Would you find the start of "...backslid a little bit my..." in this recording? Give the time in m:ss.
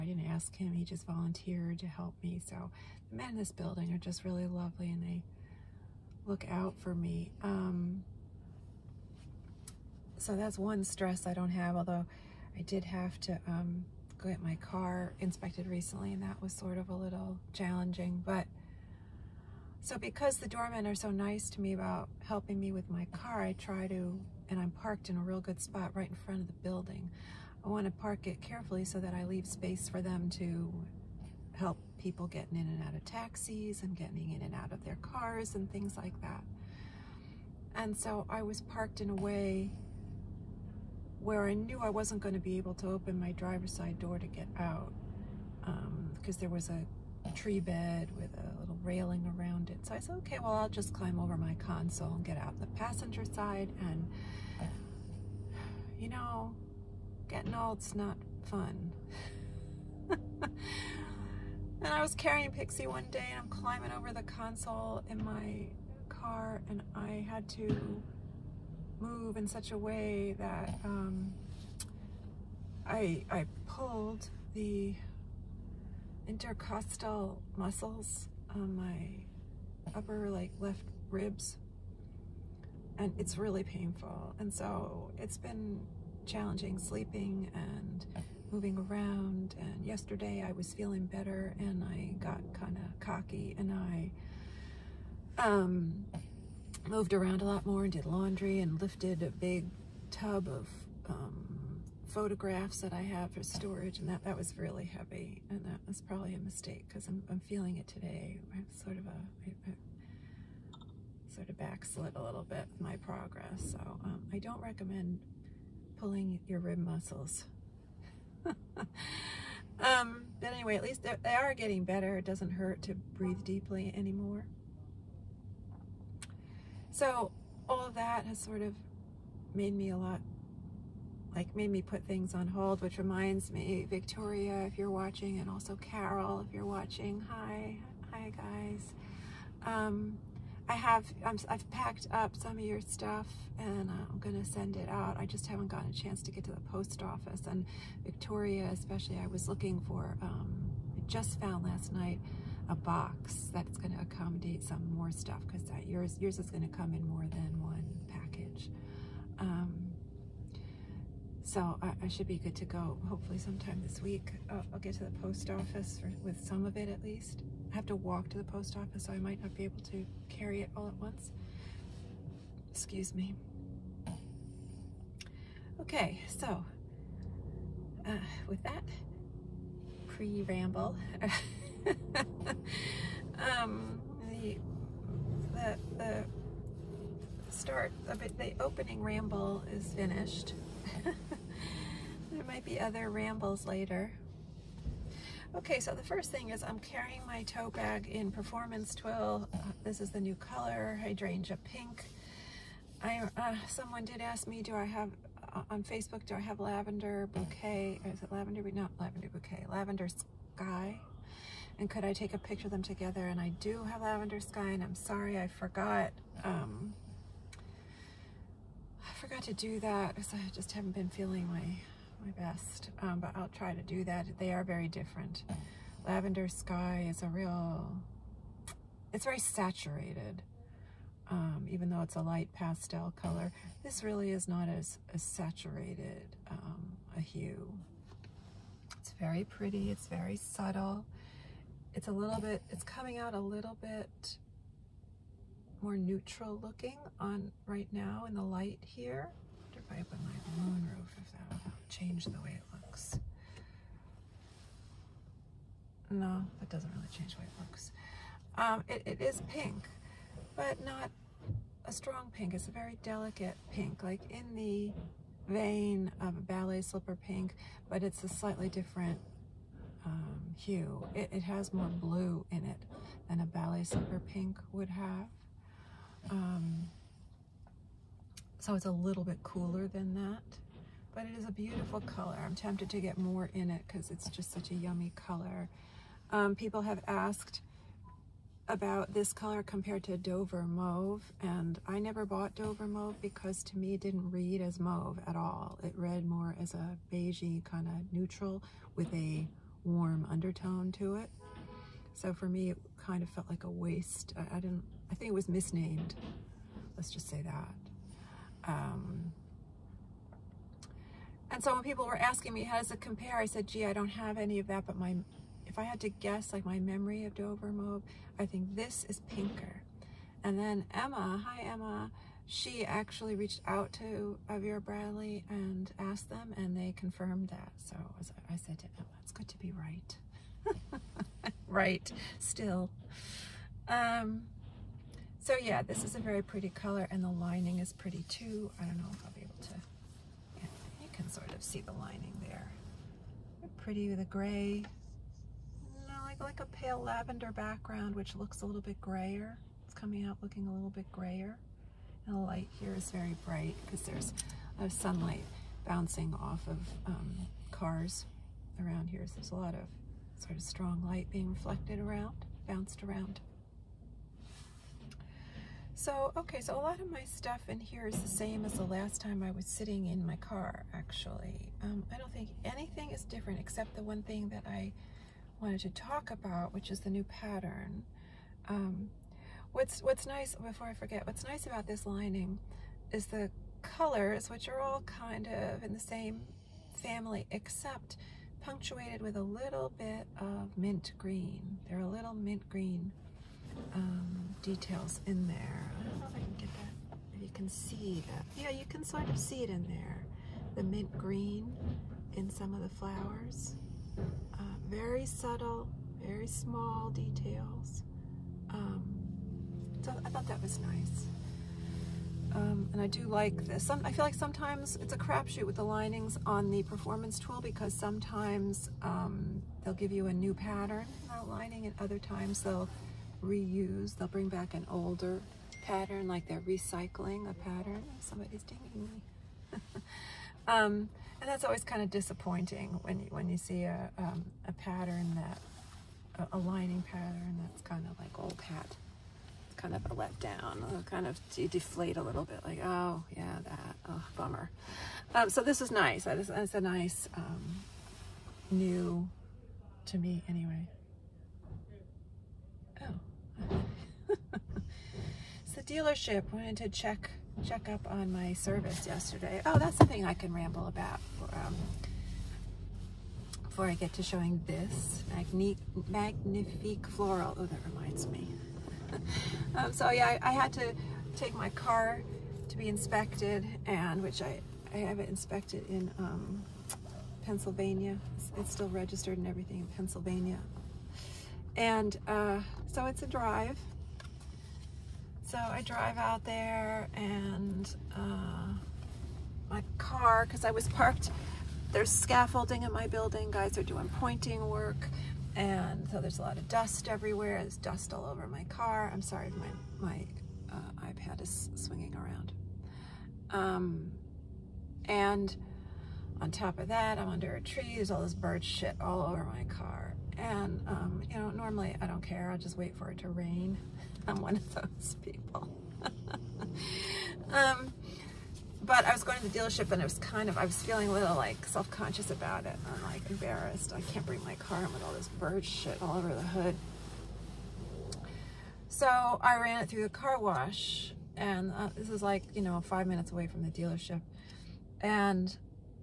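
1:51.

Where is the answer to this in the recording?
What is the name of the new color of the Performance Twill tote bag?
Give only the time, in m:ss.
3:21.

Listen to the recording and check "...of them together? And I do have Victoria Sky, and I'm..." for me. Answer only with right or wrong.
wrong.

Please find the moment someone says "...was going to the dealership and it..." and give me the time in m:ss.
8:39.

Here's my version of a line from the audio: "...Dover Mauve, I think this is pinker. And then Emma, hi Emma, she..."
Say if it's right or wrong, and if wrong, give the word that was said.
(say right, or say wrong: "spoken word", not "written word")
right.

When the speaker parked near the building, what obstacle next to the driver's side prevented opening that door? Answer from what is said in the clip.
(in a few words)
Tree bed.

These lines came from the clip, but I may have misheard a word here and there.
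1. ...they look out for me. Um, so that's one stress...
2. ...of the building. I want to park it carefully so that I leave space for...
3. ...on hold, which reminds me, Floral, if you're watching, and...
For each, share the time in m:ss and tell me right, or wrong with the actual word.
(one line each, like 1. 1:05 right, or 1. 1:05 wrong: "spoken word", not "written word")
1. 0:05 right
2. 0:26 right
3. 2:12 wrong: "Victoria", not "Floral".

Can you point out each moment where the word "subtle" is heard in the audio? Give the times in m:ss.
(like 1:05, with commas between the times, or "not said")
4:00, 6:45.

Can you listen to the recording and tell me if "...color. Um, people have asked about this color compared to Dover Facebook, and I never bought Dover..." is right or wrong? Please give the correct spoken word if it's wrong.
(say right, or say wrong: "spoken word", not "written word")
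wrong: "Mauve", not "Facebook".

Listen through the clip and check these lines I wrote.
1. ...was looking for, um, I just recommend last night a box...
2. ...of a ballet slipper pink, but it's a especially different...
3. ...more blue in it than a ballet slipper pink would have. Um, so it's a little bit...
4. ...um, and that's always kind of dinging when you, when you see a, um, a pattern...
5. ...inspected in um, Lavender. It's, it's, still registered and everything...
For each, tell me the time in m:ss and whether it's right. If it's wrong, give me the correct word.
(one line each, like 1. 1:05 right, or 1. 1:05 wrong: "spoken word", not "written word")
1. 2:29 wrong: "found", not "recommend"
2. 4:26 wrong: "slightly", not "especially"
3. 4:31 right
4. 7:10 wrong: "disappointing", not "dinging"
5. 7:55 wrong: "Pennsylvania", not "Lavender".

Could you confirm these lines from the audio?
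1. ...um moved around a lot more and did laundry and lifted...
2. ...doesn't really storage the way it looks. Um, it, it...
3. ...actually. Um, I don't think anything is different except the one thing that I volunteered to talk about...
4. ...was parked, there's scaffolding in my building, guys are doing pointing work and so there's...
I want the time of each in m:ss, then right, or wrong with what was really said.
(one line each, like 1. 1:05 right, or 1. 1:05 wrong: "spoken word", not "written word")
1. 1:35 right
2. 4:16 wrong: "change", not "storage"
3. 6:10 wrong: "wanted", not "volunteered"
4. 8:10 right.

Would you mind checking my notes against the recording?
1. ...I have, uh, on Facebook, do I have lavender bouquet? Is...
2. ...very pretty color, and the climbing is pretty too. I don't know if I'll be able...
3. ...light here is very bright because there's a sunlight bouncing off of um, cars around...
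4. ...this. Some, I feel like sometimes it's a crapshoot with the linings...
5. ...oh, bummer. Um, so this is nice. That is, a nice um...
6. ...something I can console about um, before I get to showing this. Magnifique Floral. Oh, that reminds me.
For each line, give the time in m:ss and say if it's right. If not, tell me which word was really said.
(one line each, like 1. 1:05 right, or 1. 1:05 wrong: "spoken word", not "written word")
1. 3:24 right
2. 5:36 wrong: "lining", not "climbing"
3. 5:52 right
4. 6:53 right
5. 7:24 right
6. 7:39 wrong: "ramble", not "console".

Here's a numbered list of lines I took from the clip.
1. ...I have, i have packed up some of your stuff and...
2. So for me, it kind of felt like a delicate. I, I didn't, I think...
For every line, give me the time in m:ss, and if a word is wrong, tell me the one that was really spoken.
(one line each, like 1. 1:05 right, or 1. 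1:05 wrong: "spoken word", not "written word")
1. 2:20 right
2. 5:02 wrong: "waste", not "delicate".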